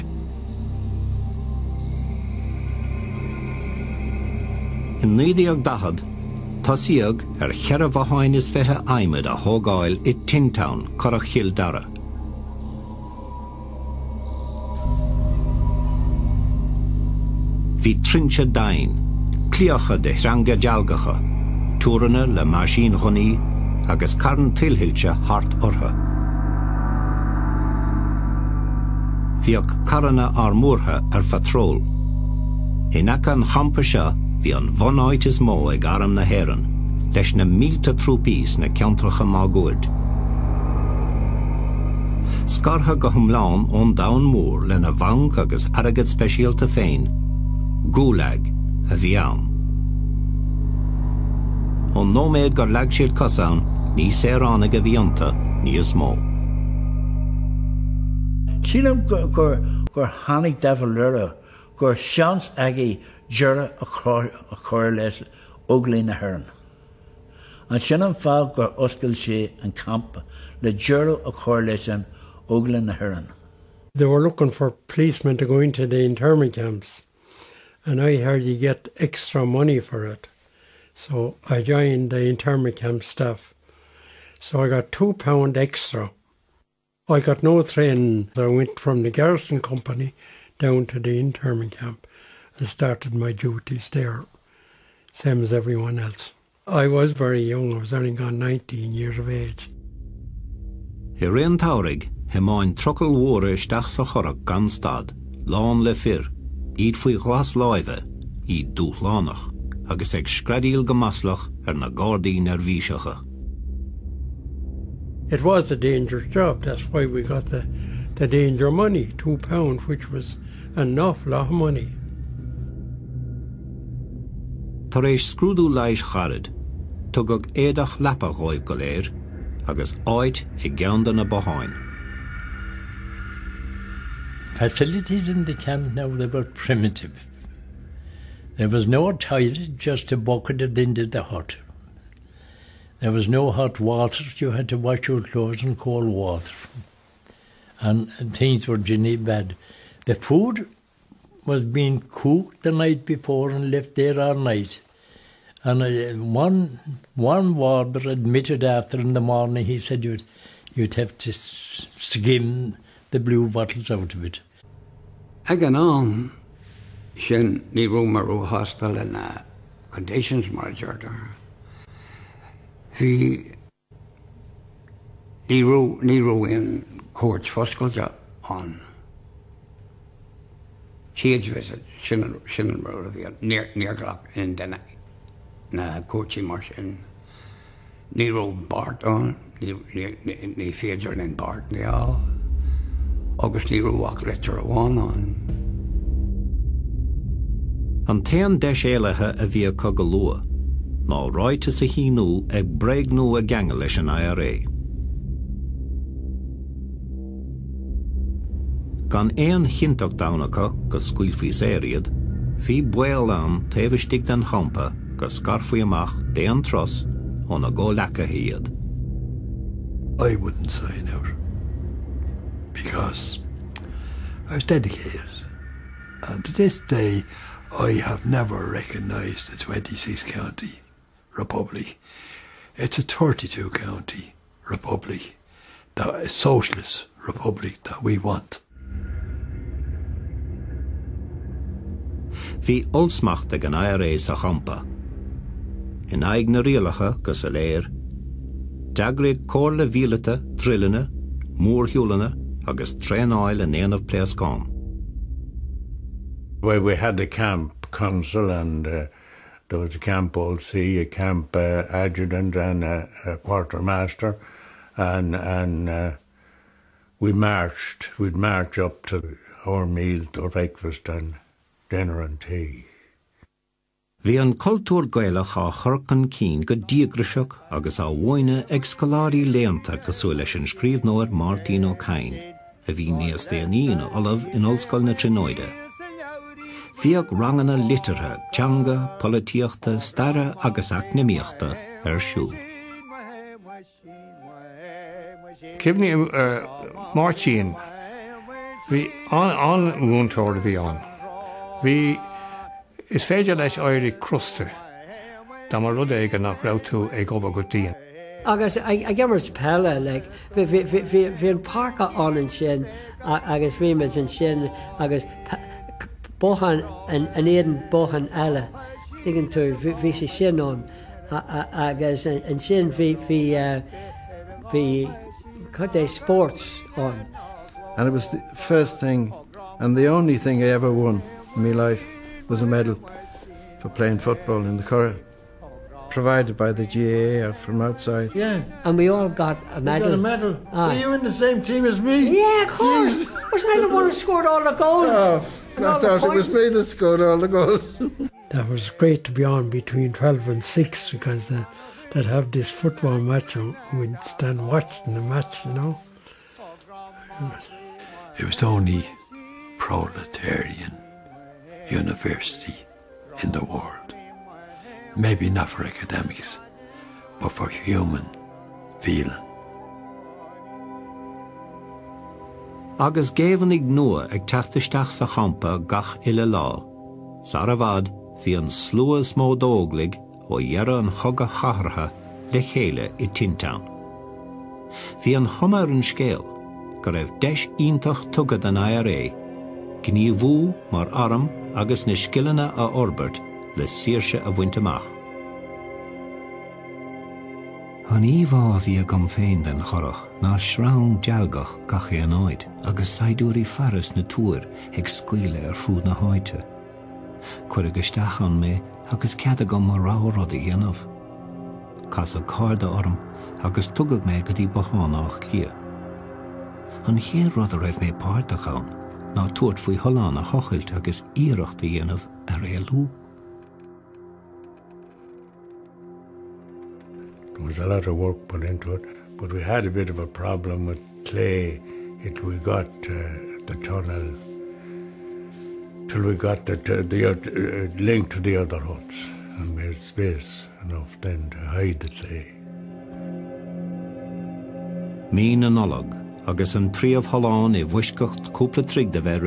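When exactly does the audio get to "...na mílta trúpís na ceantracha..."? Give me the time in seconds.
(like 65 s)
37 s.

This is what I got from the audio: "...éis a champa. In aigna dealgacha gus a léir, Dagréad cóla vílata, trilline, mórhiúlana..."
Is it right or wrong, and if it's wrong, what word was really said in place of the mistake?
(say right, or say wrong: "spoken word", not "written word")
wrong: "rialacha", not "dealgacha".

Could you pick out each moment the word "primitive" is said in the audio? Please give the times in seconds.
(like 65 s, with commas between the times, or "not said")
136 s.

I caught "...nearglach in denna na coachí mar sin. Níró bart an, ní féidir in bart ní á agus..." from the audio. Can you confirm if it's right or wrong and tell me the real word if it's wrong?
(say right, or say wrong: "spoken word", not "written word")
right.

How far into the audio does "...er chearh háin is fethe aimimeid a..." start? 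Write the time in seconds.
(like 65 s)
7 s.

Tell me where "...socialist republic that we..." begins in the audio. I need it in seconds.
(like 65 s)
236 s.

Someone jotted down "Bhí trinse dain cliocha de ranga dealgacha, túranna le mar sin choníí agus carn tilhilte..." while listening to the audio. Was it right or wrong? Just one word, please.
right.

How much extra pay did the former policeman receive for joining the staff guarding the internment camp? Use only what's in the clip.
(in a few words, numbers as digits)
2 pounds.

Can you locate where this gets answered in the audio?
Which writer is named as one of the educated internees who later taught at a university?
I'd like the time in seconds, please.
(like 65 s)
281 s.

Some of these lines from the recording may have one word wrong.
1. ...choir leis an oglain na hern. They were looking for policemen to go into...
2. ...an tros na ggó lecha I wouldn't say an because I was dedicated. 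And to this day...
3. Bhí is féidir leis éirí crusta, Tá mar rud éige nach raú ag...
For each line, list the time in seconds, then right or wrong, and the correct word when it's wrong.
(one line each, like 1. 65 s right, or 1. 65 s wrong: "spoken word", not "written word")
1. 71 s right
2. 216 s right
3. 301 s right.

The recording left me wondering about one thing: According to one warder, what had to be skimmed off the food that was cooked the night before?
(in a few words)
blue bottles.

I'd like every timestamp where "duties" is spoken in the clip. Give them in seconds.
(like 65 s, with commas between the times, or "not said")
93 s.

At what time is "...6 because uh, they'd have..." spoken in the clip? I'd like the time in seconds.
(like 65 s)
350 s.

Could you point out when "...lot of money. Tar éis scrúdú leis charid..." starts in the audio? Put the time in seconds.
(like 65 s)
121 s.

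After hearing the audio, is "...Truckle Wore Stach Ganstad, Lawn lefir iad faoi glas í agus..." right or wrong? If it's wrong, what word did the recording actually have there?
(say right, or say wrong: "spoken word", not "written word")
right.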